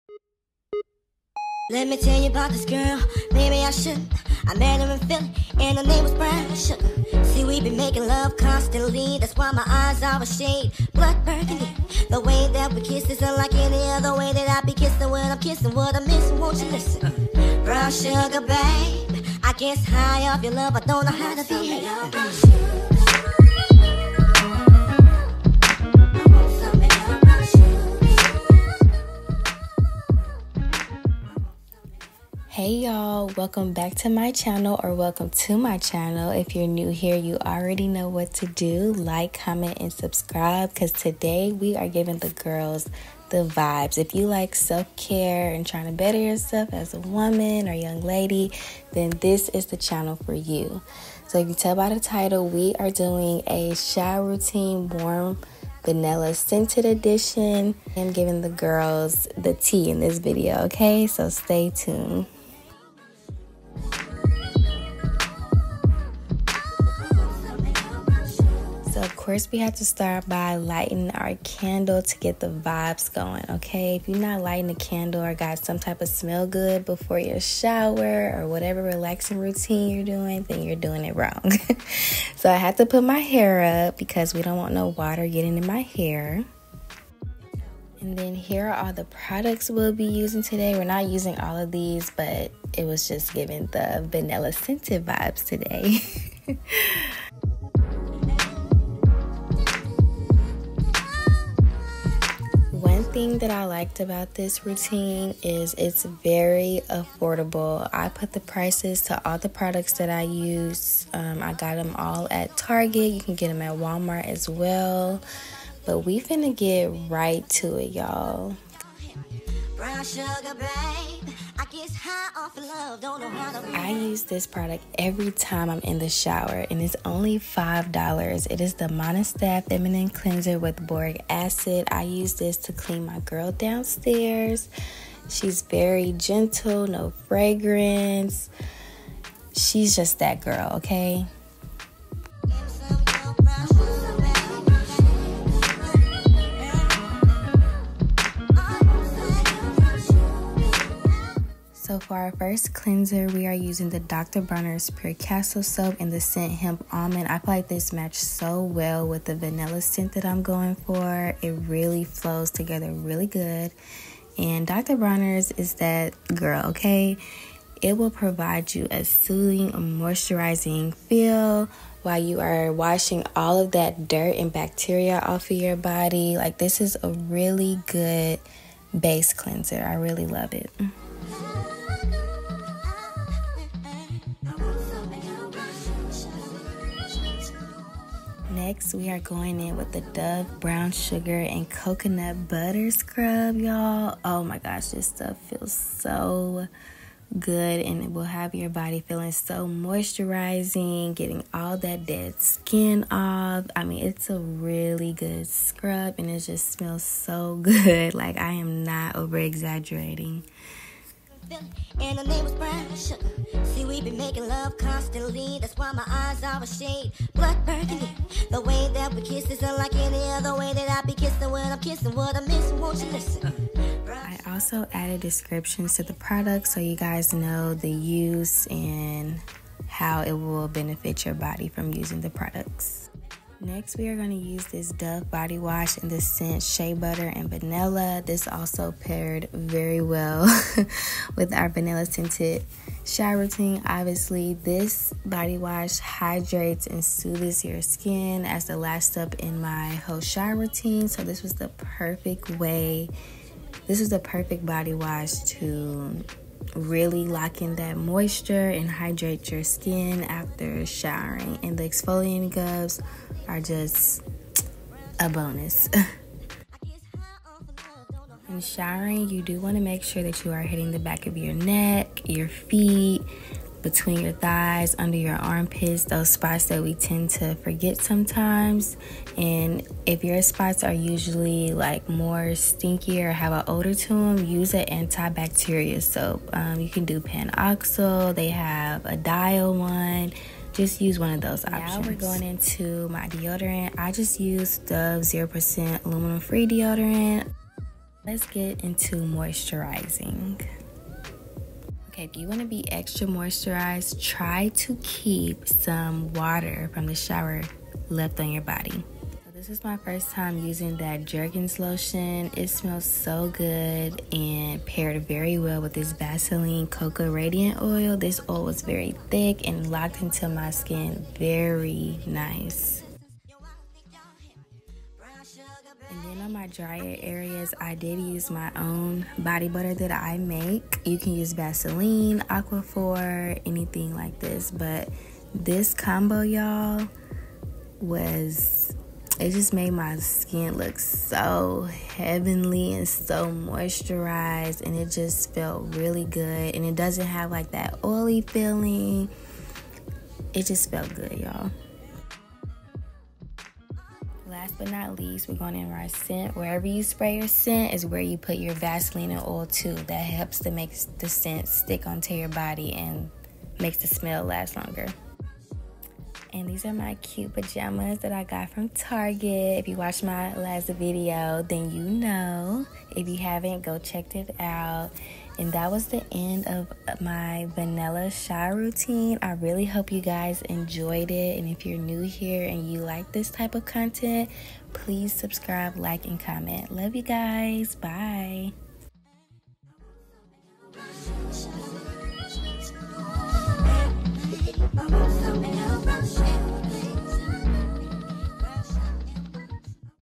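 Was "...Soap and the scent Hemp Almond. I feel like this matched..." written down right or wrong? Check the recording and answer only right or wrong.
right.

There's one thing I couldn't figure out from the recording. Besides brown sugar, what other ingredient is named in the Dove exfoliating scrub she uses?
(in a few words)
Coconut butter.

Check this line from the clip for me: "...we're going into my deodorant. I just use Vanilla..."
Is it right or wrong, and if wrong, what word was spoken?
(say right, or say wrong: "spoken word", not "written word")
wrong: "Dove", not "Vanilla".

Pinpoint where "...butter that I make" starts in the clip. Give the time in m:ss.
5:29.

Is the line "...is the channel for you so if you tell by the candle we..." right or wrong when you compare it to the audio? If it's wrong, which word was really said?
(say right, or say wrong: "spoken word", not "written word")
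wrong: "title", not "candle".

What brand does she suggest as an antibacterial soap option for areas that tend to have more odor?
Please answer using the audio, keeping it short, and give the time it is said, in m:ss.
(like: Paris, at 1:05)
Panoxyl, at 4:47.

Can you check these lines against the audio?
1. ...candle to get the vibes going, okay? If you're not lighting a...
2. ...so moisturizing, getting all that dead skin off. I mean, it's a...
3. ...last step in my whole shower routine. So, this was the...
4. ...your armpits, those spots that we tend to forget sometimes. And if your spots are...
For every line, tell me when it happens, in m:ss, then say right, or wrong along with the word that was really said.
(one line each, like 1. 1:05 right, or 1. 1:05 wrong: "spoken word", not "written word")
1. 1:11 right
2. 3:19 right
3. 4:08 right
4. 4:35 right.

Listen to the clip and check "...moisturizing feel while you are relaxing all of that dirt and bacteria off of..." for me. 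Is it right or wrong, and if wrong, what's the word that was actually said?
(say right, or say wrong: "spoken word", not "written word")
wrong: "washing", not "relaxing".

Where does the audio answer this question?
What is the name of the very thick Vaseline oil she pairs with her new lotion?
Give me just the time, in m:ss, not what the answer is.
5:16.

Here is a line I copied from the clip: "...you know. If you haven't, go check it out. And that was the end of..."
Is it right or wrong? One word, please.
right.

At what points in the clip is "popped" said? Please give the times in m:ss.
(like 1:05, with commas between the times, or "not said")
not said.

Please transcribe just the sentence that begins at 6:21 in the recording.
And if you're new here and you like this type of content, please subscribe, like, and comment.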